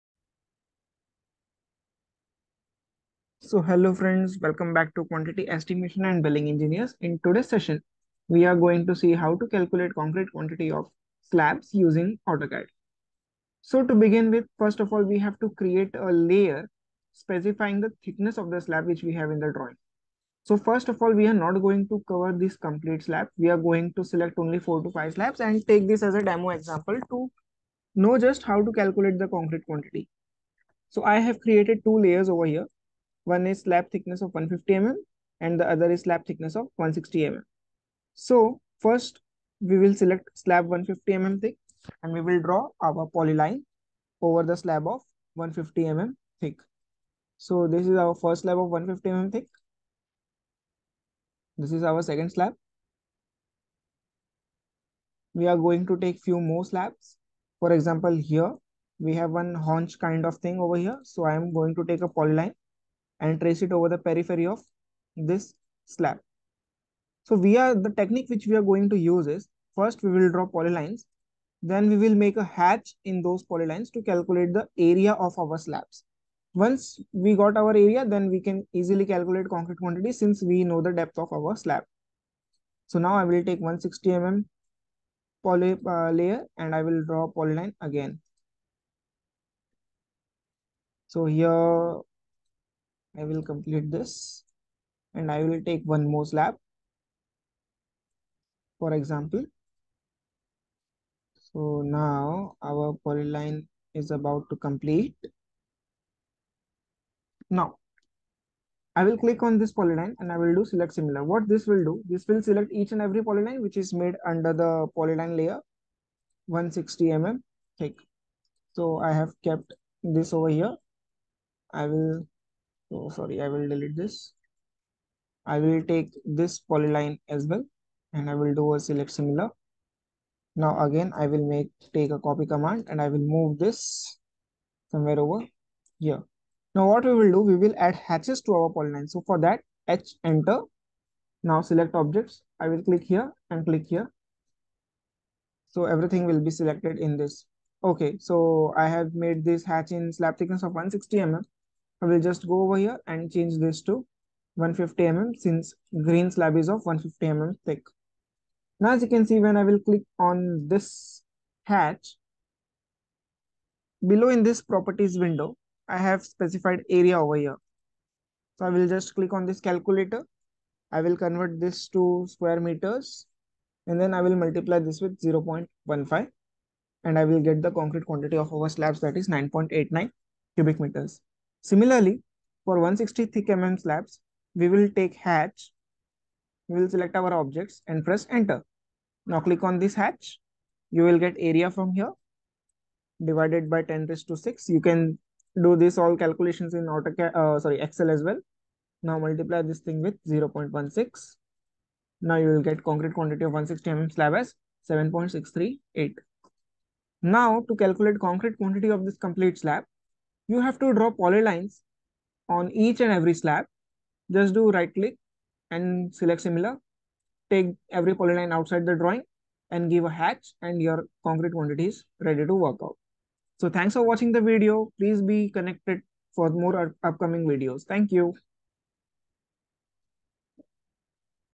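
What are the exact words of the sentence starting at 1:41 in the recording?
So now our polyline is about to complete.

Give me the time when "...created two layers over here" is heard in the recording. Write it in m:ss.
0:31.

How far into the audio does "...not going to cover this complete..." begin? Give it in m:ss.
0:21.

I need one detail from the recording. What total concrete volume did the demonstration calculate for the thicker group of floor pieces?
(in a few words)
7.638.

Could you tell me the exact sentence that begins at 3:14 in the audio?
You can do this all calculations in AutoCAD, uh, sorry, Excel as well.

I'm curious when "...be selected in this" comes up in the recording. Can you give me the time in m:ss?
2:26.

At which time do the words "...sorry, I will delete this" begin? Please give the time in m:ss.
2:03.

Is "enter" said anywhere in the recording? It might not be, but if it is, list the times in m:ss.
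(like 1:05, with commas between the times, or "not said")
2:20, 3:08.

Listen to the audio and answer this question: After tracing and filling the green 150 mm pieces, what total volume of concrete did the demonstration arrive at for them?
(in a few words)
9.89 cubic meters.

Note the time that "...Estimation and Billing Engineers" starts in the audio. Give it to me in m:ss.
0:05.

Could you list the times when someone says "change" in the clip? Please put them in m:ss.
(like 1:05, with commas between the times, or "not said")
2:33.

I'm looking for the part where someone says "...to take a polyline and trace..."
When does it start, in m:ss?
1:01.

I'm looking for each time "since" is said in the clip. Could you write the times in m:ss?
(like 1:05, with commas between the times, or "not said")
1:20, 2:35.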